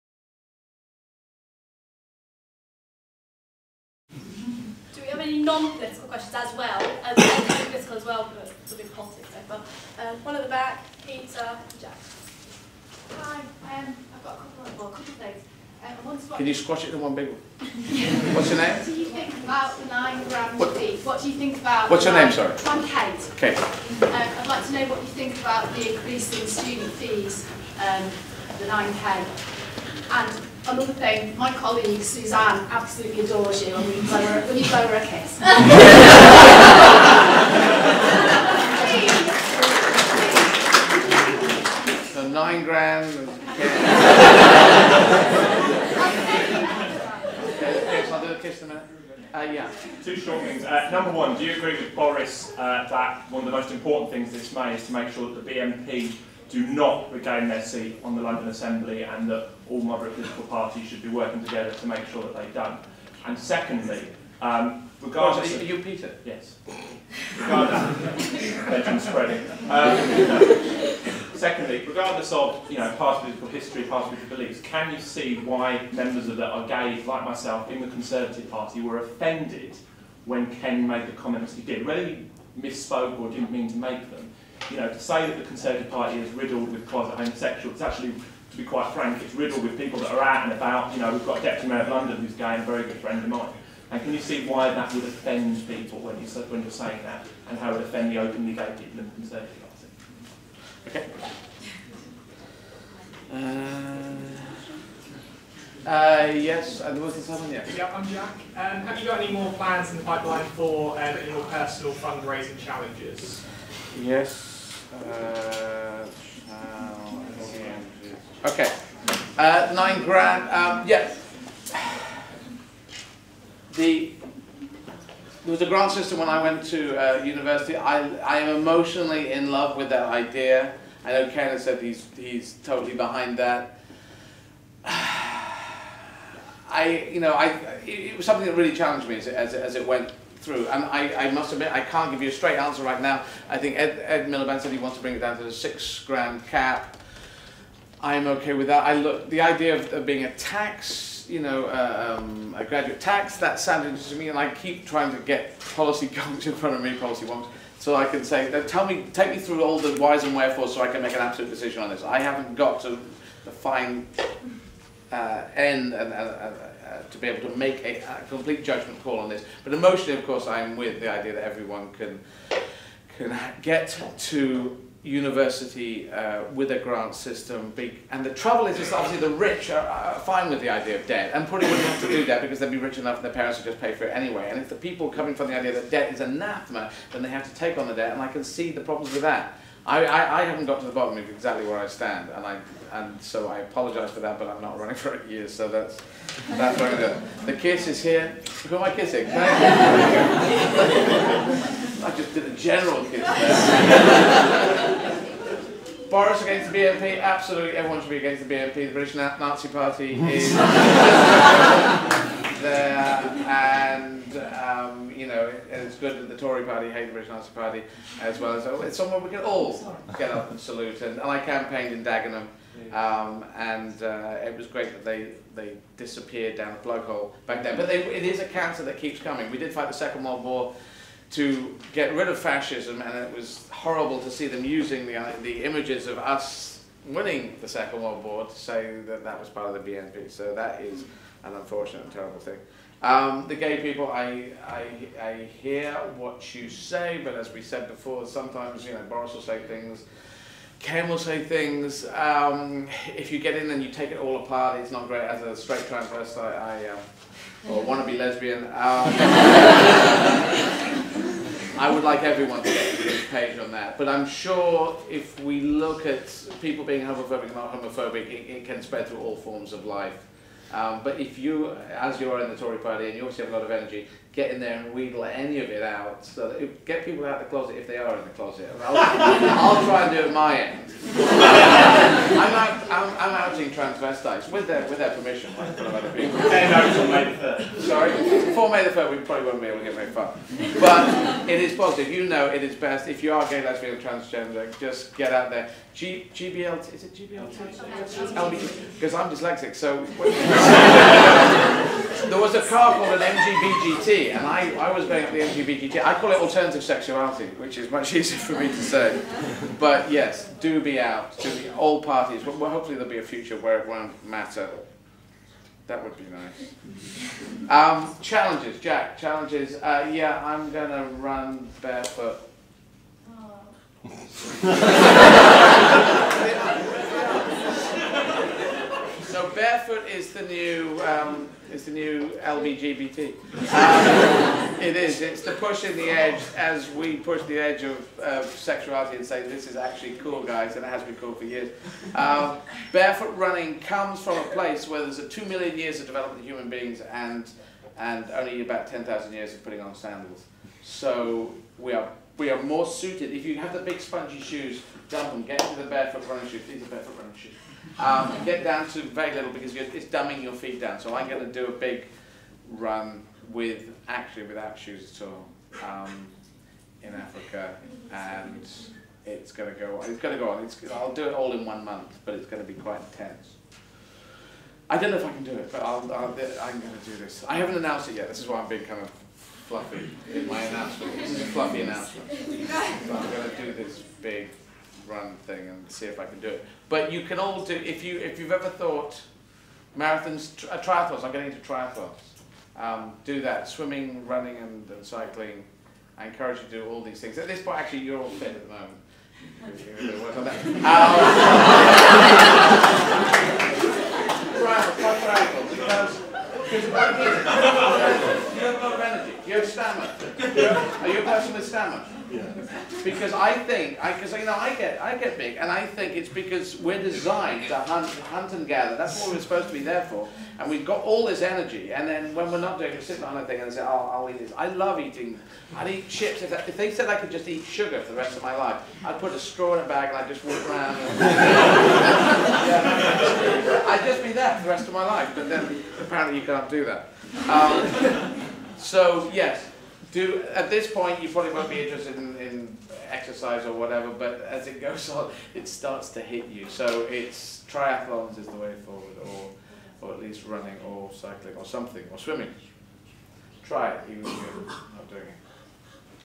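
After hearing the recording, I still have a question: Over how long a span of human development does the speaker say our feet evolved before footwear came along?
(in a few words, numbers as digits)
2 million years.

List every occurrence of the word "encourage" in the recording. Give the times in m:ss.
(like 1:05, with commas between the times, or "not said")
6:36.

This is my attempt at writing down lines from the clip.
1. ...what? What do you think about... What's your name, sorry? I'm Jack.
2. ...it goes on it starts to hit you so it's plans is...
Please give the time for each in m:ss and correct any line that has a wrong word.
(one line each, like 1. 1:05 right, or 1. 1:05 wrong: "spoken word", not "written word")
1. 0:20 wrong: "Kate", not "Jack"
2. 7:24 wrong: "triathlons", not "plans".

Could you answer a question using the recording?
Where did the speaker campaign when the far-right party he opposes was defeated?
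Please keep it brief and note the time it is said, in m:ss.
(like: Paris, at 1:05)
Dagenham, at 3:42.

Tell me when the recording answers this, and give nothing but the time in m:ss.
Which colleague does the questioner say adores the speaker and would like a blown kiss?
0:32.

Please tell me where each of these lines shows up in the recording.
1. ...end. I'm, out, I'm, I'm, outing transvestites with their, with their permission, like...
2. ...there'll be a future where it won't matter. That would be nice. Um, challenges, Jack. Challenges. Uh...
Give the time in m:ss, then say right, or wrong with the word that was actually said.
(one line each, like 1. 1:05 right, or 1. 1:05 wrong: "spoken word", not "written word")
1. 4:40 right
2. 5:12 right.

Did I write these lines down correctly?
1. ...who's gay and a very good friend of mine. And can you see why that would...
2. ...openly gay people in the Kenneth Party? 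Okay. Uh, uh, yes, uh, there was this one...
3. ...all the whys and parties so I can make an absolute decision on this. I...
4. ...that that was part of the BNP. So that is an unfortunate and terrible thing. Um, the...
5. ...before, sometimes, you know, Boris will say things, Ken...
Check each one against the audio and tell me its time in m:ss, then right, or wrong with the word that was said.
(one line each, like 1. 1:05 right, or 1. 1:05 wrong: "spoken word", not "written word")
1. 1:32 right
2. 1:38 wrong: "Conservative", not "Kenneth"
3. 2:39 wrong: "wherefores", not "parties"
4. 3:59 right
5. 4:07 right.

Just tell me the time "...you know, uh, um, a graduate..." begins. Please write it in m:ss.
2:31.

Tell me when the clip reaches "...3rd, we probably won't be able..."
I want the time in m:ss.
4:48.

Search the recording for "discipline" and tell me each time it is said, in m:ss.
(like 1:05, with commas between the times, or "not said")
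not said.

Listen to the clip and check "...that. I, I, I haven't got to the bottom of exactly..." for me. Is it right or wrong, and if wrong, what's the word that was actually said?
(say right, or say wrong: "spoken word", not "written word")
right.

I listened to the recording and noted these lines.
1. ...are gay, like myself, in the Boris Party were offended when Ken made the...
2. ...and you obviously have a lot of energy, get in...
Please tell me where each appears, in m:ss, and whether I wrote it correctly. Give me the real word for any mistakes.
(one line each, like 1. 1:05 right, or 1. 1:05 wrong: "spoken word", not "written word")
1. 1:16 wrong: "Conservative", not "Boris"
2. 4:33 right.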